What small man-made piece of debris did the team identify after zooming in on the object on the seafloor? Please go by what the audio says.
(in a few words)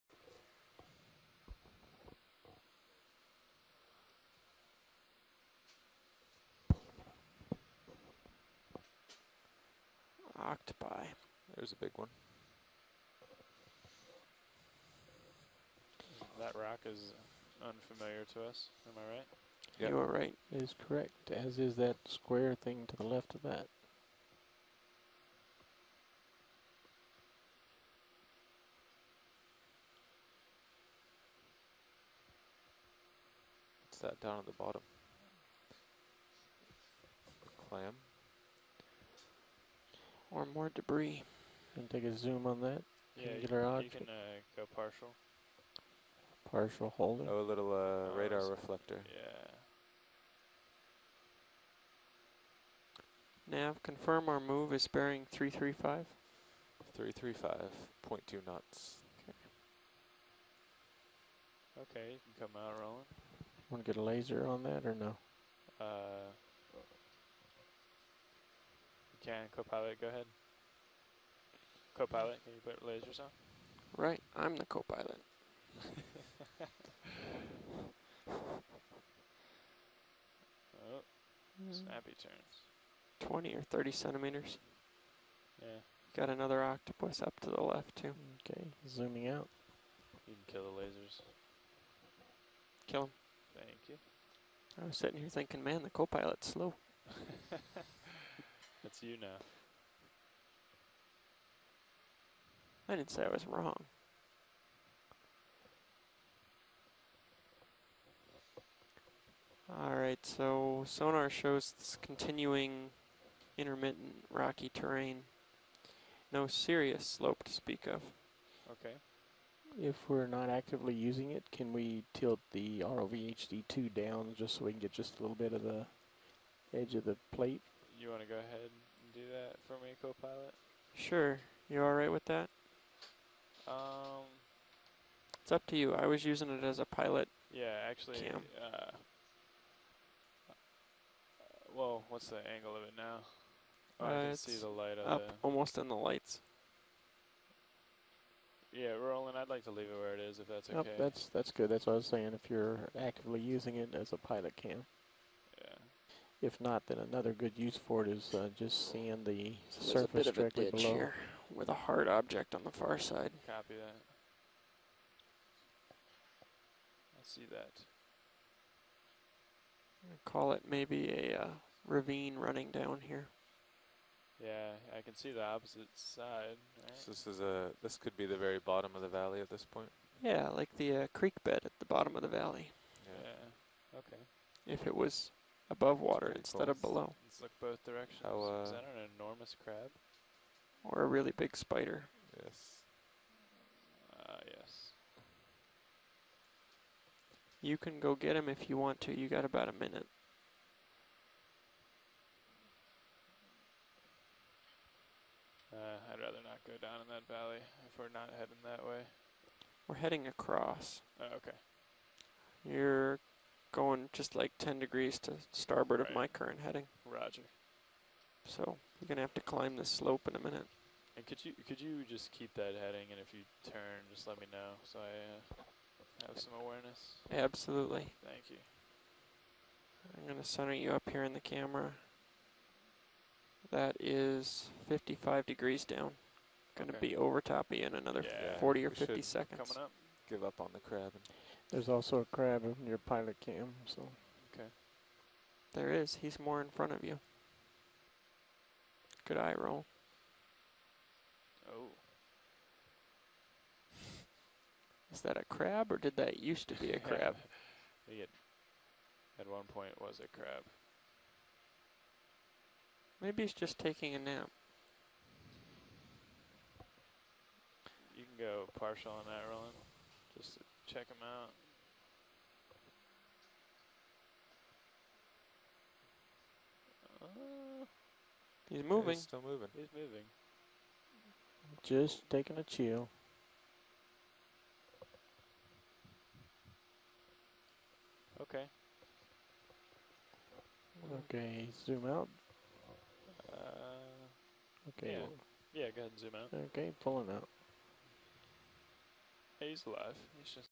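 radar reflector.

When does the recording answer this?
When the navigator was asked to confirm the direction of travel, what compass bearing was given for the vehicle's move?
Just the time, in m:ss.
0:55.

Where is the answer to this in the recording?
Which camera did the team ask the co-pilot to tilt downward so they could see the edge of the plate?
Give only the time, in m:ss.
2:02.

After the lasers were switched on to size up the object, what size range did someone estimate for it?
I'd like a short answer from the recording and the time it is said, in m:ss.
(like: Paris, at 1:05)
20 or 30 centimeters, at 1:23.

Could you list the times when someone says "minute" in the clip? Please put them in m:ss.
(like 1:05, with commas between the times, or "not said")
3:19, 3:40.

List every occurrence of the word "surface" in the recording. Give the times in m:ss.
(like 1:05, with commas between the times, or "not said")
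2:40.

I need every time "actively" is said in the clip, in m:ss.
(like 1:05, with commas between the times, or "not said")
2:00, 2:32.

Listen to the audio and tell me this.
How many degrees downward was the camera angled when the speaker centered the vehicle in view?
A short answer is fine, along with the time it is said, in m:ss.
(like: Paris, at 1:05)
55 degrees, at 3:54.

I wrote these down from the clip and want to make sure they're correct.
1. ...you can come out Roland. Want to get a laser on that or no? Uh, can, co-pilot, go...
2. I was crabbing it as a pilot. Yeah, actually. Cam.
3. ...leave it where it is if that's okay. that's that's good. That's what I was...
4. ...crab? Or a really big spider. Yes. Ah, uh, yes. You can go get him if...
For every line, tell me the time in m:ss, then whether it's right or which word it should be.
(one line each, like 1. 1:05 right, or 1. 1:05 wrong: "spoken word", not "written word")
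1. 1:02 right
2. 2:15 wrong: "using", not "crabbing"
3. 2:29 right
4. 3:09 right.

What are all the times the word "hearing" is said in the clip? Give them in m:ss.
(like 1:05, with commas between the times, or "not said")
not said.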